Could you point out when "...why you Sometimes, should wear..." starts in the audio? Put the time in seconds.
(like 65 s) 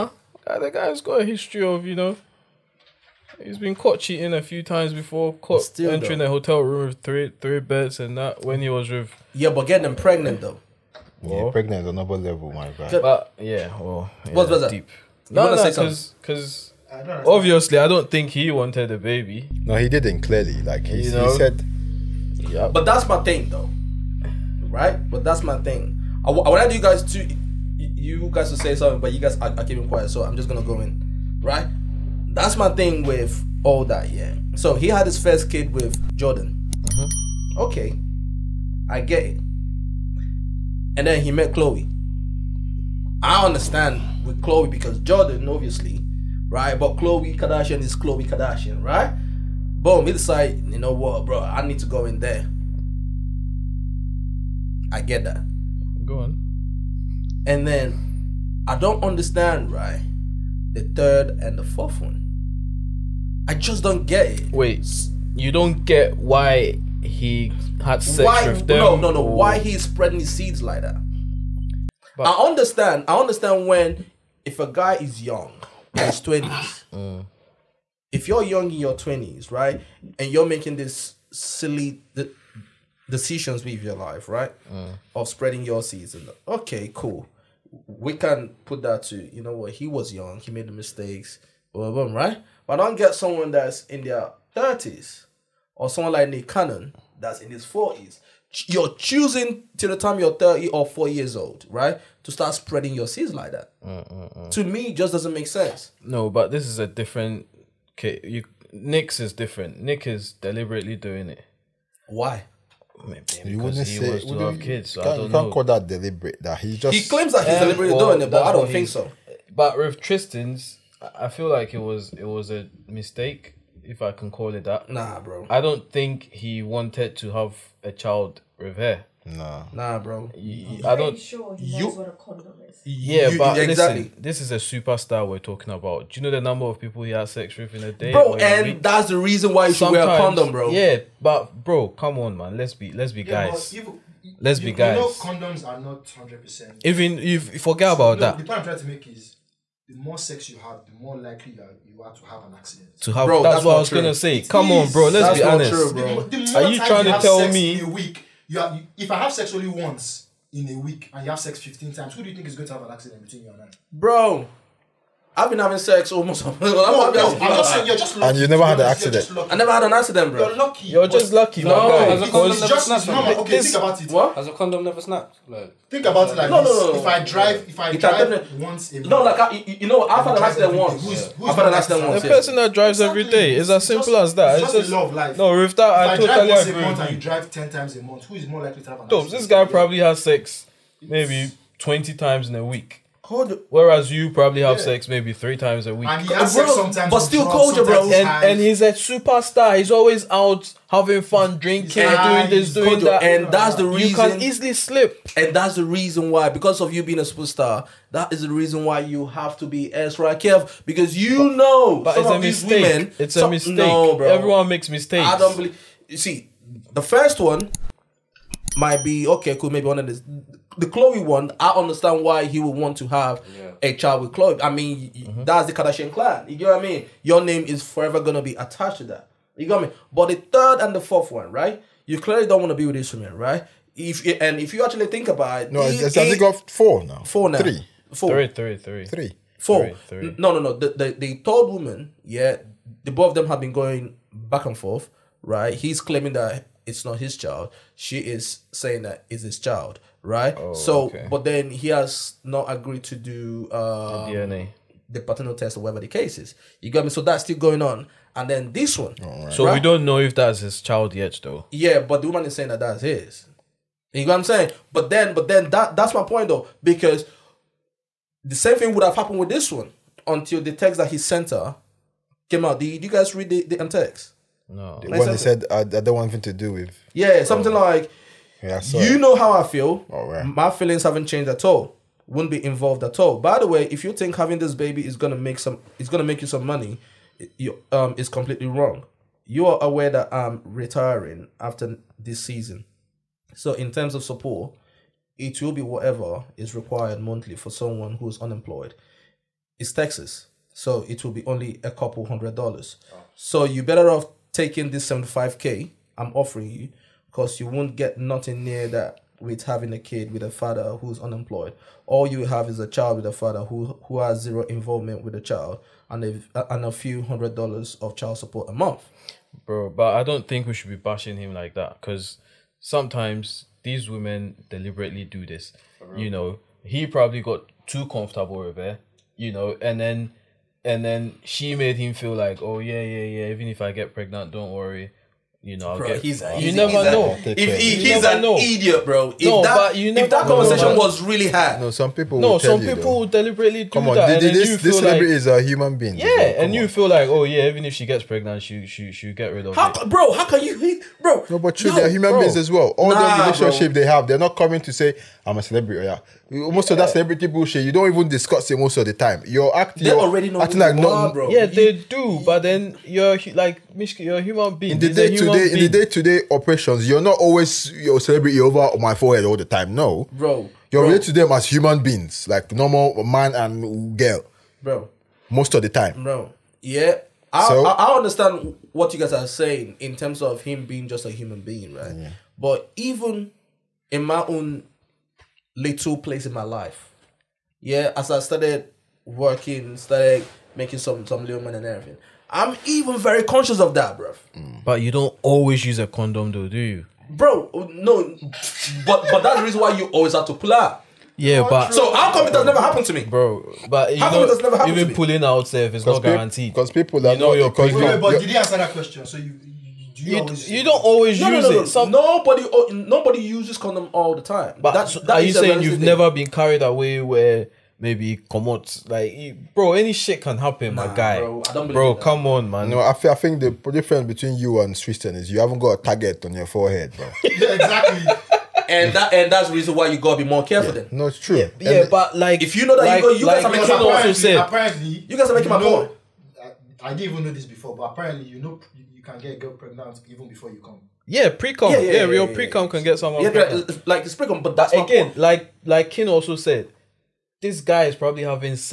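139 s.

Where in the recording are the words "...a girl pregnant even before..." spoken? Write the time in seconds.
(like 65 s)
439 s.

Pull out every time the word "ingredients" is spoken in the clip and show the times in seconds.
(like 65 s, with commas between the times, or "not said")
not said.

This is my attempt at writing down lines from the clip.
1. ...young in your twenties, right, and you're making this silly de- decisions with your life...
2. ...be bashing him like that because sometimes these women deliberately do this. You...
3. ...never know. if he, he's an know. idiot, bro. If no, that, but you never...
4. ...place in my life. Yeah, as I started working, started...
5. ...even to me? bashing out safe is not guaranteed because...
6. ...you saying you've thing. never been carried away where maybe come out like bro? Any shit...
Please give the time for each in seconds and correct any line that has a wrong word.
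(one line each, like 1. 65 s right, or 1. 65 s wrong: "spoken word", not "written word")
1. 78 s right
2. 320 s right
3. 336 s right
4. 386 s right
5. 404 s wrong: "pulling", not "bashing"
6. 415 s right.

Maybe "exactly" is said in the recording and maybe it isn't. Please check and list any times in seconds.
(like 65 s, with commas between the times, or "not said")
133 s, 427 s.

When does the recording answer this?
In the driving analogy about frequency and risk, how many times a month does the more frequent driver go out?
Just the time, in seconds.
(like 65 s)
187 s.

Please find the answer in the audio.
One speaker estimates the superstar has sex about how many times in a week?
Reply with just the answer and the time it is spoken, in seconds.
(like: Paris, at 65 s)
20, at 191 s.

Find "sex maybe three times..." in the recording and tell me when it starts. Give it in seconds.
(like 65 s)
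194 s.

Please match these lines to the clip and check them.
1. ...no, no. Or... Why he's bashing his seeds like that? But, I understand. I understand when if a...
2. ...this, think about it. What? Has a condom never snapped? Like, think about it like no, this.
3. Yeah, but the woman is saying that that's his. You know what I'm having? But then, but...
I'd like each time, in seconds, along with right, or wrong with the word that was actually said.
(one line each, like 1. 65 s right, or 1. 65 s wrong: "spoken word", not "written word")
1. 68 s wrong: "spreading", not "bashing"
2. 173 s right
3. 261 s wrong: "saying", not "having".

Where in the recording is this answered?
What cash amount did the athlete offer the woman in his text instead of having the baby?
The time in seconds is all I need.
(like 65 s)
305 s.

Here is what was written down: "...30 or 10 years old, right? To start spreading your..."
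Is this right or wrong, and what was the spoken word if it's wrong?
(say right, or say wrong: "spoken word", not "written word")
wrong: "40", not "10".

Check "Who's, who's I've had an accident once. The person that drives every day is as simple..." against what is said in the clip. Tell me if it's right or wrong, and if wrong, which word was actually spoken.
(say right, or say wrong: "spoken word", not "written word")
right.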